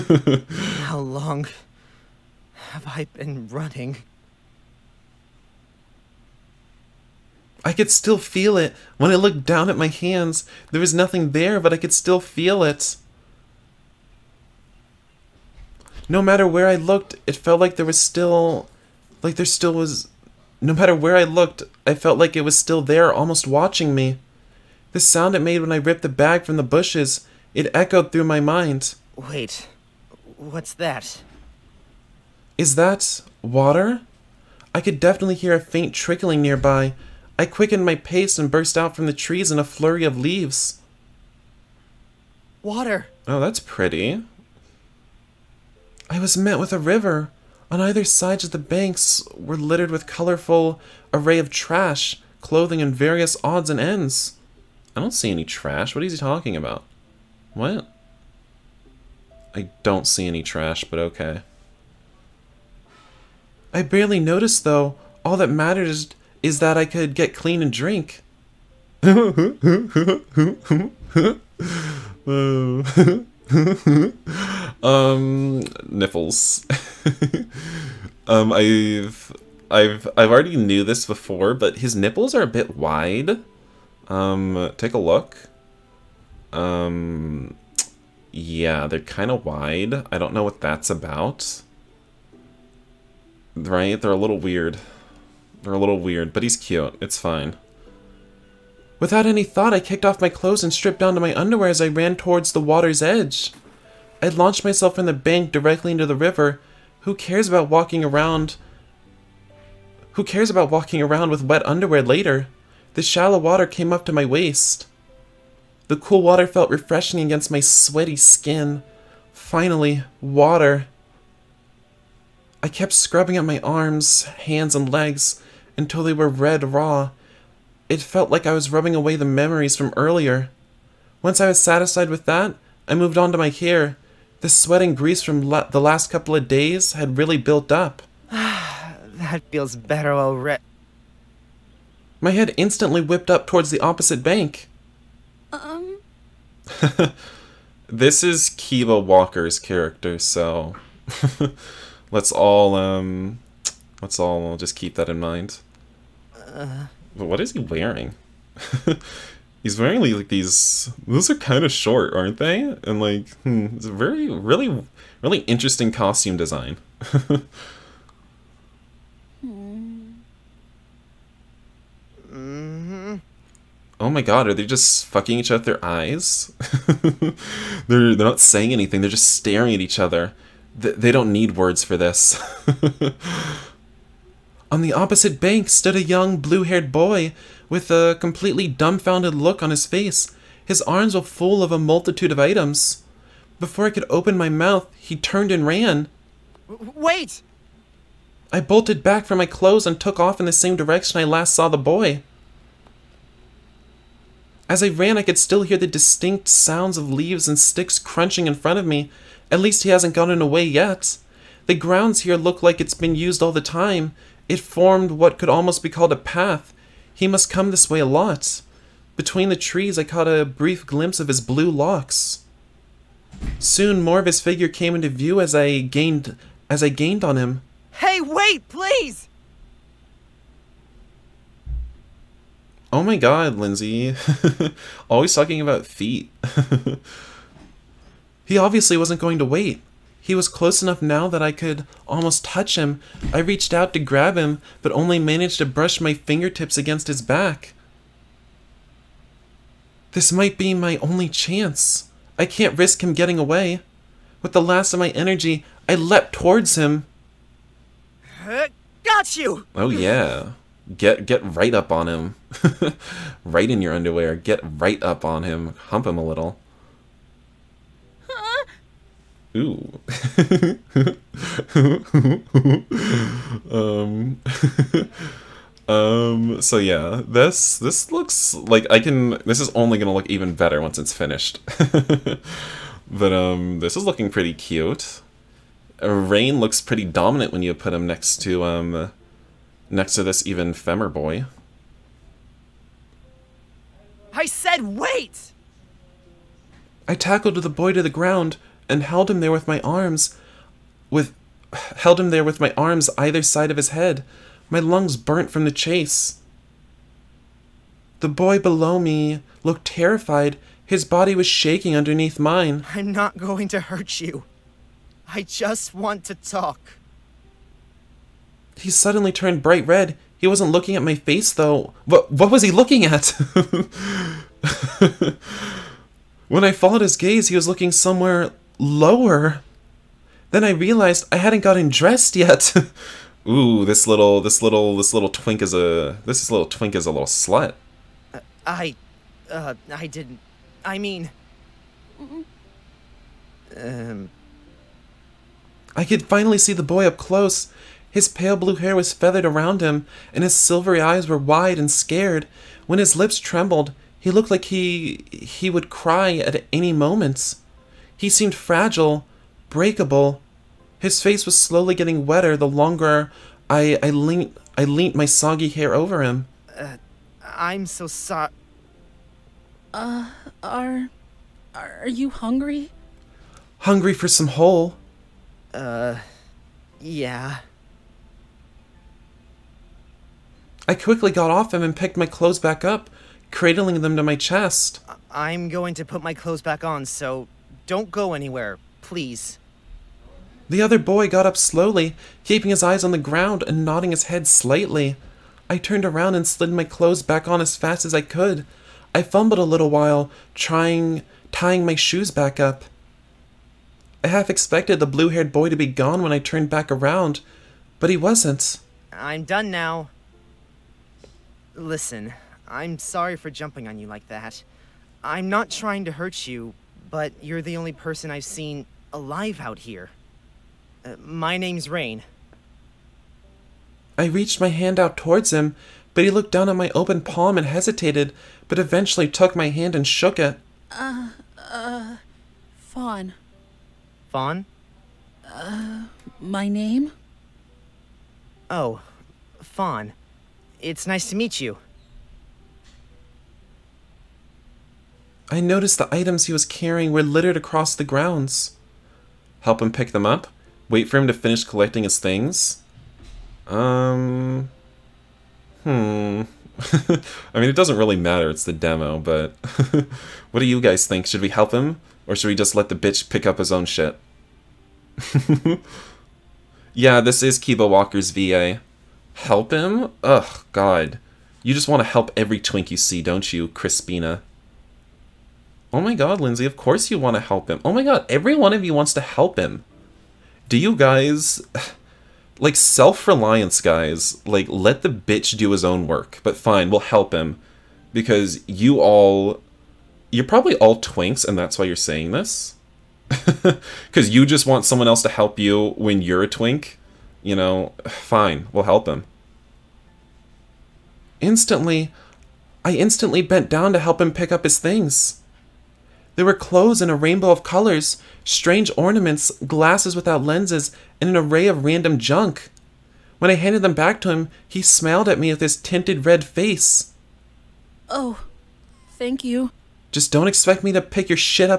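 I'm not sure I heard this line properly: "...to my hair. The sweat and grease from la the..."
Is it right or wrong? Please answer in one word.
right.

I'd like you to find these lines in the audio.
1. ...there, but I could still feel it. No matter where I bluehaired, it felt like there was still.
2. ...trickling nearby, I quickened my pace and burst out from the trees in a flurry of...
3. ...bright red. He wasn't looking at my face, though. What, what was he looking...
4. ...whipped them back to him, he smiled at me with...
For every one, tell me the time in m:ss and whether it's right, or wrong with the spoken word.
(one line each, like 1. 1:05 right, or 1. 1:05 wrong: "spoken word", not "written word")
1. 0:11 wrong: "looked", not "bluehaired"
2. 0:35 right
3. 5:19 right
4. 8:33 wrong: "handed", not "whipped".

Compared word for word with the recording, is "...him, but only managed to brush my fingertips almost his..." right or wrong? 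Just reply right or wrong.
wrong.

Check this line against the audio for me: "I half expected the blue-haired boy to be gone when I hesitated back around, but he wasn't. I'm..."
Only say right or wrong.
wrong.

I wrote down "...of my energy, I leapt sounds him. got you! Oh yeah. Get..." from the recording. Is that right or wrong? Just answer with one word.
wrong.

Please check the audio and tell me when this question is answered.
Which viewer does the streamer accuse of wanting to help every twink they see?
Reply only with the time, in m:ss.
7:53.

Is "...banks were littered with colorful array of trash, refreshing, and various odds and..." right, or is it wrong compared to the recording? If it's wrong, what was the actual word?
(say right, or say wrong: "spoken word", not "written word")
wrong: "clothing", not "refreshing".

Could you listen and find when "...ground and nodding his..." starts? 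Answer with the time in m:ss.
6:33.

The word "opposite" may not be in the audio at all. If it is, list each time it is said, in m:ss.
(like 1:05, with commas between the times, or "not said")
2:23, 3:04.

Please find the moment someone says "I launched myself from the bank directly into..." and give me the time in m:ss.
1:44.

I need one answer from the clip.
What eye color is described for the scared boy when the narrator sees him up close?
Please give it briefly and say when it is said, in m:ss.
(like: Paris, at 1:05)
Silvery, at 5:50.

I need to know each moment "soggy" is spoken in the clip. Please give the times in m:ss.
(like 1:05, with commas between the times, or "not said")
6:05.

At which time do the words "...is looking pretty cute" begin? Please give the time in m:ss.
4:43.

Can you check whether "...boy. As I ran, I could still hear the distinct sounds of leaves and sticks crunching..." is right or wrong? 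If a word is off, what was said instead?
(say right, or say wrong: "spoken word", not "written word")
right.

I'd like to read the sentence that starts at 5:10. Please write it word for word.
His body was shaking underneath mine.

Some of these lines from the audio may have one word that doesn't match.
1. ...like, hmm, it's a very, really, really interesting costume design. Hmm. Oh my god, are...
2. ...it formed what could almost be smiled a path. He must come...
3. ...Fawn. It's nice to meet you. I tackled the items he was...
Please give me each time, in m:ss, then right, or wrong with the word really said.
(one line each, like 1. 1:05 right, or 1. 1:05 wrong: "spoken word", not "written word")
1. 2:43 right
2. 3:34 wrong: "called", not "smiled"
3. 7:19 wrong: "noticed", not "tackled".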